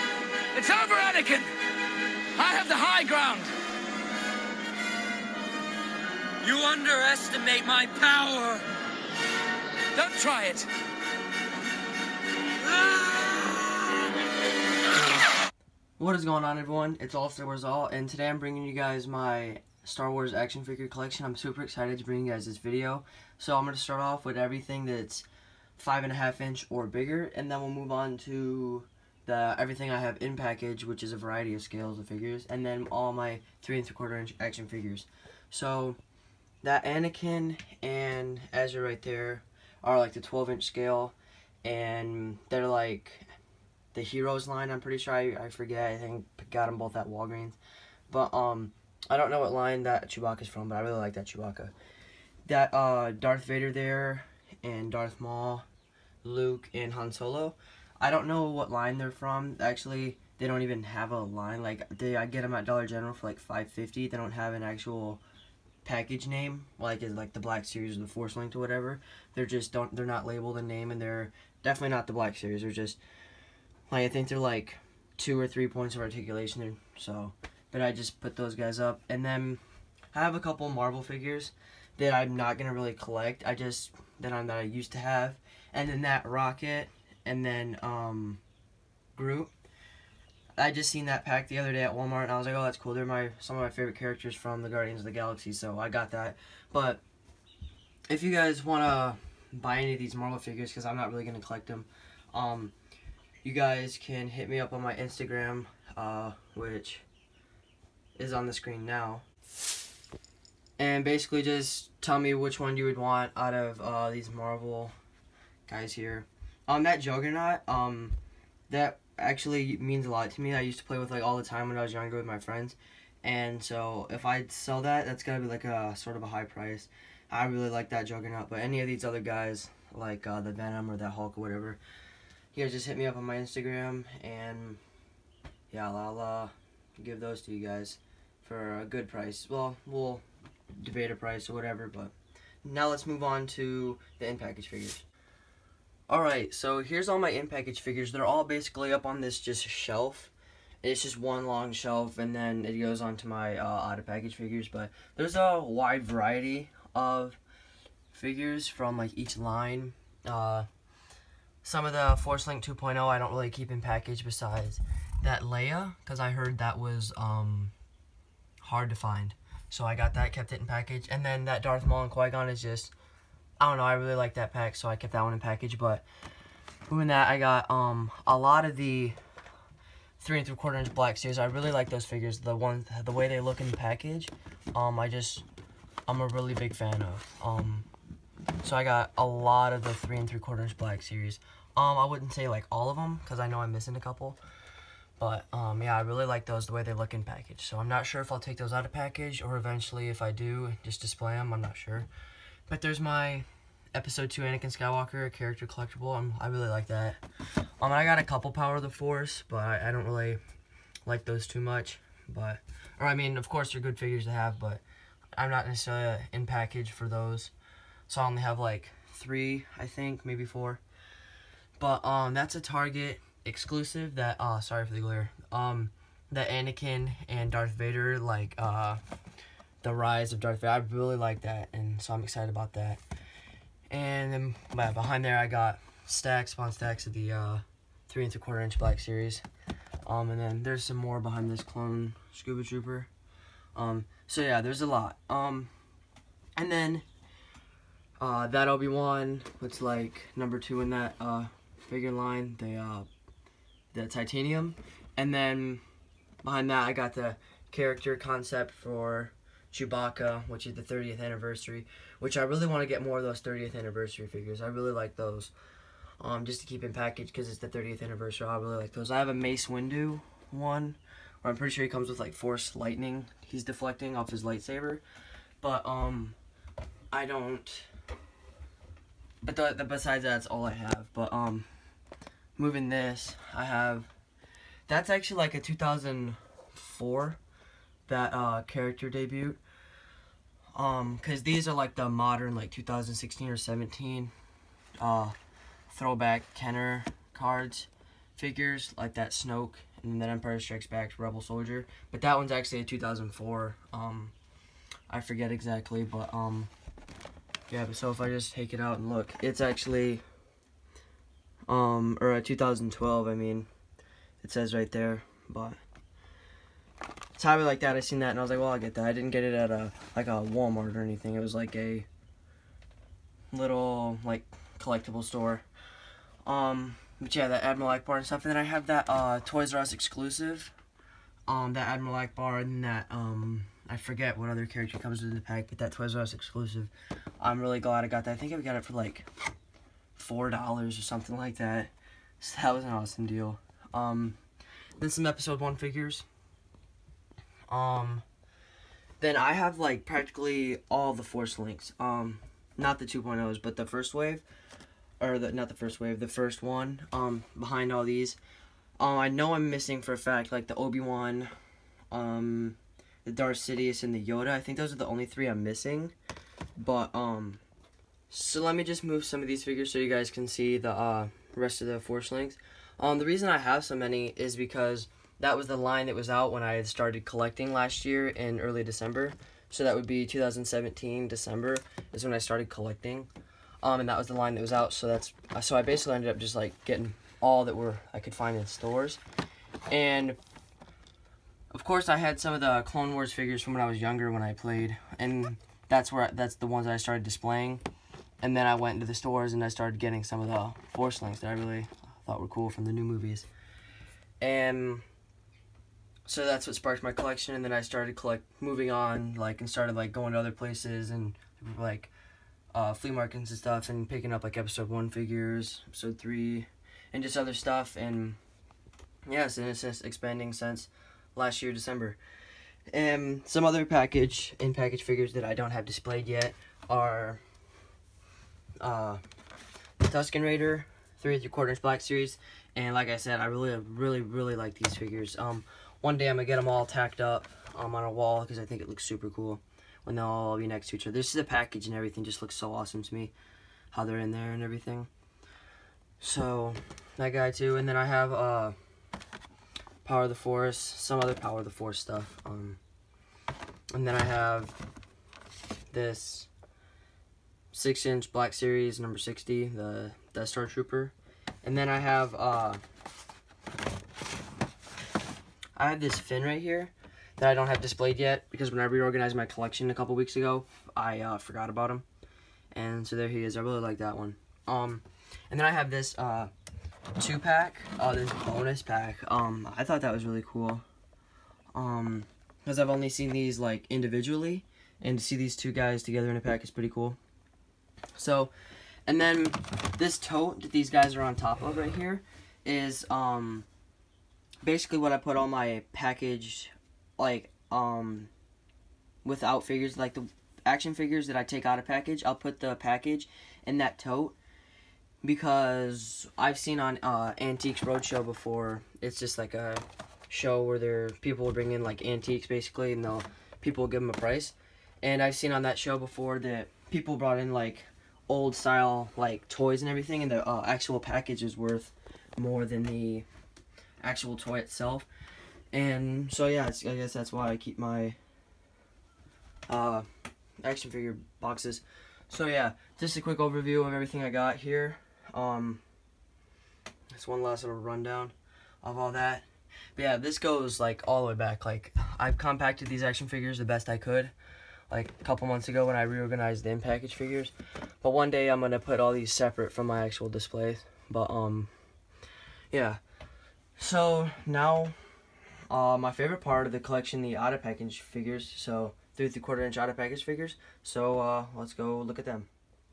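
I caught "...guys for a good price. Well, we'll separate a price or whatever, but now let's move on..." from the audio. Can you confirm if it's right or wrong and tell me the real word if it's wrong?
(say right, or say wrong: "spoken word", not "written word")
wrong: "debate", not "separate".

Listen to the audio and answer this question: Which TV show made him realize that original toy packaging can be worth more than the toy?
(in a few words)
Antiques Roadshow.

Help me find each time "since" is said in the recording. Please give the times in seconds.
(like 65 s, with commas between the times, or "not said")
420 s.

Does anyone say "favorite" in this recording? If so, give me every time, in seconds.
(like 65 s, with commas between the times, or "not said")
93 s, 556 s.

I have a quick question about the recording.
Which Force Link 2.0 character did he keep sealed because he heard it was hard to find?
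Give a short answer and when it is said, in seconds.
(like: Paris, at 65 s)
Leia, at 165 s.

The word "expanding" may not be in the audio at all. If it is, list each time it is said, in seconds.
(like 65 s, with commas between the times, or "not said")
420 s.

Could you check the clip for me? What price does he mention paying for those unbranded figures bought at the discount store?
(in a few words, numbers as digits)
$5.50.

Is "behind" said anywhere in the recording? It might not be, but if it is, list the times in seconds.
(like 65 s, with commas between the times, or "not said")
234 s, 241 s, 256 s, 357 s.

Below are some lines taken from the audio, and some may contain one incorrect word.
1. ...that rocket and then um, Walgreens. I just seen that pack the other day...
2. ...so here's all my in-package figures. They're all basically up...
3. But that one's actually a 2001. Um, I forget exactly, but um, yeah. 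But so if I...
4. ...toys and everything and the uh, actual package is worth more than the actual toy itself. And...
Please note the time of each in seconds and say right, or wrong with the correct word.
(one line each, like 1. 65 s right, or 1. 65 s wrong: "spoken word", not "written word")
1. 86 s wrong: "Groot", not "Walgreens"
2. 146 s right
3. 302 s wrong: "2004", not "2001"
4. 519 s right.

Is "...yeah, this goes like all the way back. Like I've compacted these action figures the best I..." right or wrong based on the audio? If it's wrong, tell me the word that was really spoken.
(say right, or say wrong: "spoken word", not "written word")
right.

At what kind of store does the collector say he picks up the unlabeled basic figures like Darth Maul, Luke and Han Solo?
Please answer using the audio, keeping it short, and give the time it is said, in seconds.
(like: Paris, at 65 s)
Dollar General, at 62 s.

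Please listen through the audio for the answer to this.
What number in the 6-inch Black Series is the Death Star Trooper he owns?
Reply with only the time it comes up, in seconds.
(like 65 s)
458 s.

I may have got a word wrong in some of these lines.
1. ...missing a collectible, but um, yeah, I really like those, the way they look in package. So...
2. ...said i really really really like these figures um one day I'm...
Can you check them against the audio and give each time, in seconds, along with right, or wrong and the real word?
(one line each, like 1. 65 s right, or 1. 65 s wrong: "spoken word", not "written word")
1. 193 s wrong: "couple", not "collectible"
2. 433 s right.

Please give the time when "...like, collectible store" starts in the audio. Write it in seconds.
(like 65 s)
324 s.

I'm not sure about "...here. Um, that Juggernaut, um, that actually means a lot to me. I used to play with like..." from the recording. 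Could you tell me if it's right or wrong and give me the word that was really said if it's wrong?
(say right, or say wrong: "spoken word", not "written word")
right.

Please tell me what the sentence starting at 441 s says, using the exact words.
This is the package and everything just looks so awesome to me, how they're in there and everything.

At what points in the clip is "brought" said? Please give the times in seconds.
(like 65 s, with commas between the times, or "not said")
517 s.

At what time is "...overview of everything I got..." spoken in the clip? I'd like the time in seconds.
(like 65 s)
533 s.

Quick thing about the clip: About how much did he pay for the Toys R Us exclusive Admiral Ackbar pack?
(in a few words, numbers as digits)
$4.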